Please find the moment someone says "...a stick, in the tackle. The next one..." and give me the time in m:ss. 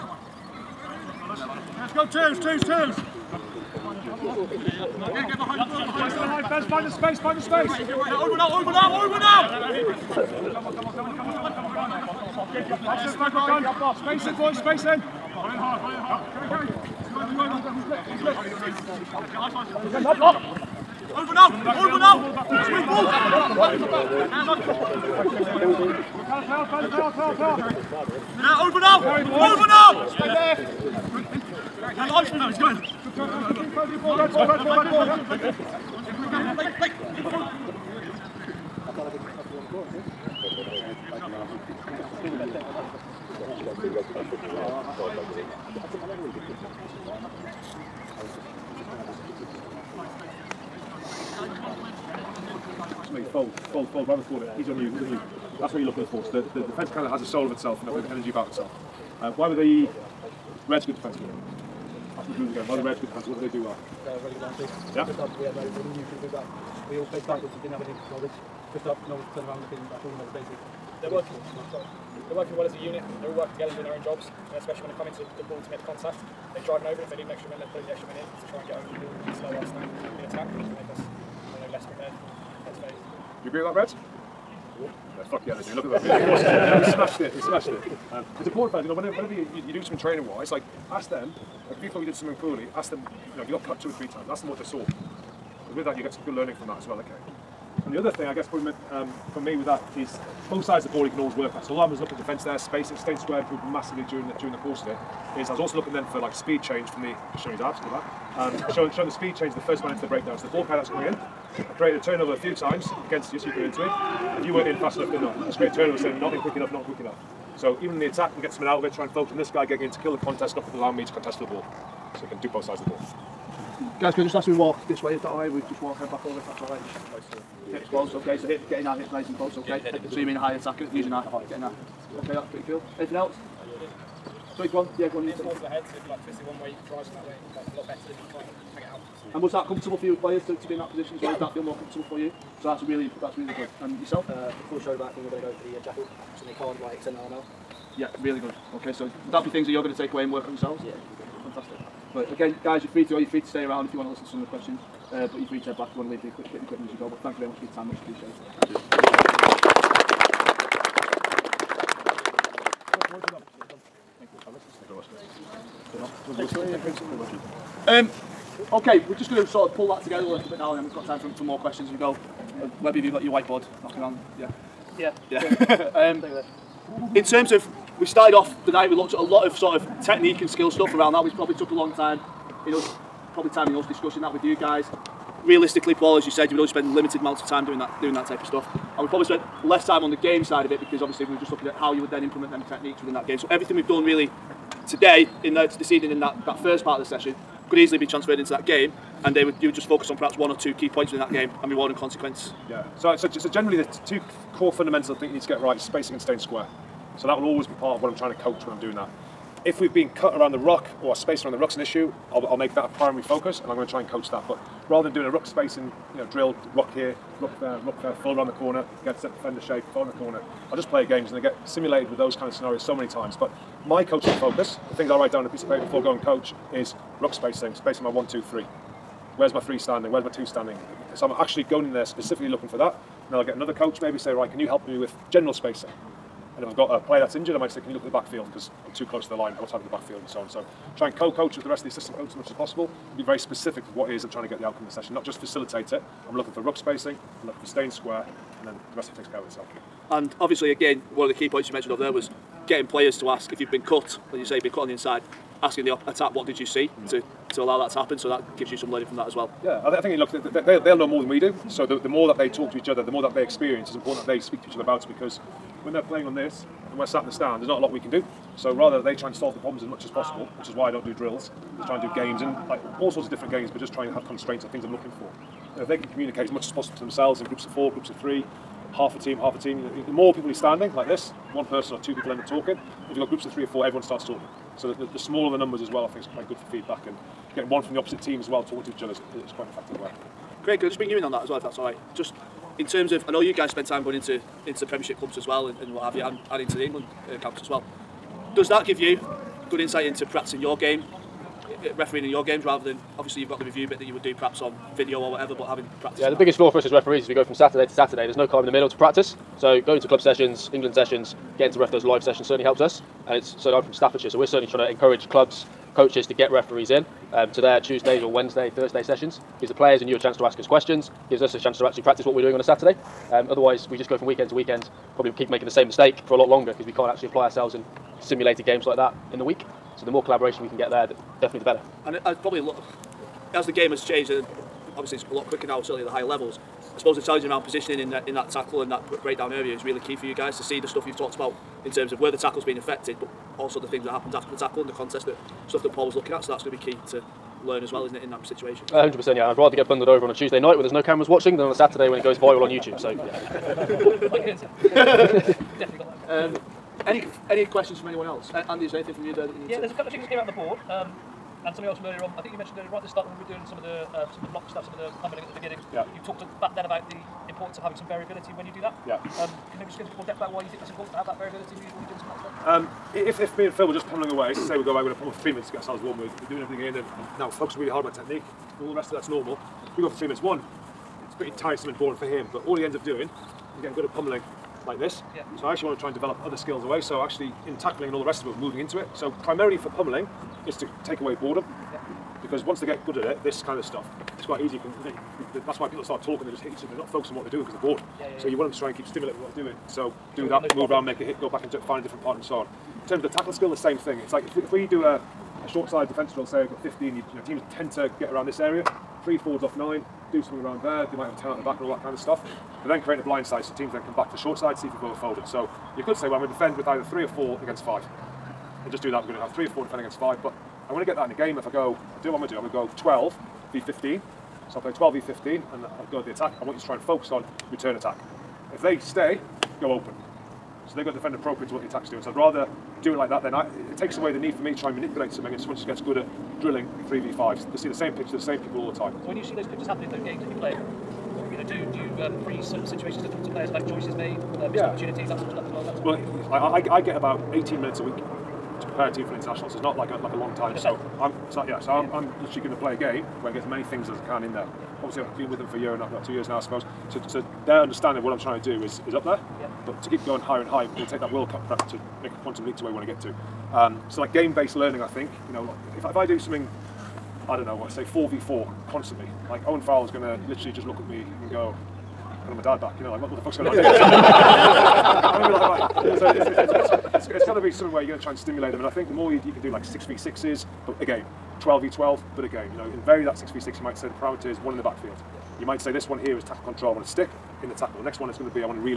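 8:07.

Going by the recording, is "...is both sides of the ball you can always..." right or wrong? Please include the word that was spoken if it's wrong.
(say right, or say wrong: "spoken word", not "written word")
right.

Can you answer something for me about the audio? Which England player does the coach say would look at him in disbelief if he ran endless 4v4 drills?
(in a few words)
Owen Farrell.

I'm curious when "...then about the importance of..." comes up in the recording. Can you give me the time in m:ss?
6:06.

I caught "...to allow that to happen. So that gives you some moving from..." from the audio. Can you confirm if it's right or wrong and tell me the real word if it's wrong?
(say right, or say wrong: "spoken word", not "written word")
wrong: "learning", not "moving".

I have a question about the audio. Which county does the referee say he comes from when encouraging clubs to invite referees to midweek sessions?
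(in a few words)
Staffordshire.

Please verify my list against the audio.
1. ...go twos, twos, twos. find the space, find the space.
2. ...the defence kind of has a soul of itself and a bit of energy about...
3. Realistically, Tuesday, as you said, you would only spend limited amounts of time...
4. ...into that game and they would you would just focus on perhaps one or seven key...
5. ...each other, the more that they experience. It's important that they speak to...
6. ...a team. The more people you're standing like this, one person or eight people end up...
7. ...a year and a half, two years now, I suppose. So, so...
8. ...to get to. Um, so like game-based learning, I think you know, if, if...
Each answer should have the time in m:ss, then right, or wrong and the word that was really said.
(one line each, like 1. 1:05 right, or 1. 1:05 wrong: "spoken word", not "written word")
1. 0:01 right
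2. 0:56 right
3. 3:05 wrong: "Paul", not "Tuesday"
4. 3:18 wrong: "two", not "seven"
5. 4:22 right
6. 4:39 wrong: "two", not "eight"
7. 7:35 right
8. 7:43 right.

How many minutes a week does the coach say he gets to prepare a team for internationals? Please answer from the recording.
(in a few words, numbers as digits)
18 minutes.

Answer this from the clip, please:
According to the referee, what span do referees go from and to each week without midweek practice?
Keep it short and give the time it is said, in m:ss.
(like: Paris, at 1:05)
Saturday to Saturday, at 5:07.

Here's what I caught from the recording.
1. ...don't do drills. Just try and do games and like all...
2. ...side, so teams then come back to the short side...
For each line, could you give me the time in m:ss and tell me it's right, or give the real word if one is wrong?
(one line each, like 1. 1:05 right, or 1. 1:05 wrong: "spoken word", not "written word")
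1. 4:30 right
2. 6:53 right.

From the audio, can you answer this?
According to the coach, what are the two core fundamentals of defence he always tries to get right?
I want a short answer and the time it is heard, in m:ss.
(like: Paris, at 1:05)
Spacing and staying square, at 3:25.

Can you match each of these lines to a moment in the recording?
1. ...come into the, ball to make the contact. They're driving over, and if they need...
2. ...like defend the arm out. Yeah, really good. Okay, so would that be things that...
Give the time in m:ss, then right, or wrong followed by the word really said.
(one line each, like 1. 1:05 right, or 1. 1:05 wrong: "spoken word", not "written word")
1. 1:14 right
2. 2:26 wrong: "extend", not "defend".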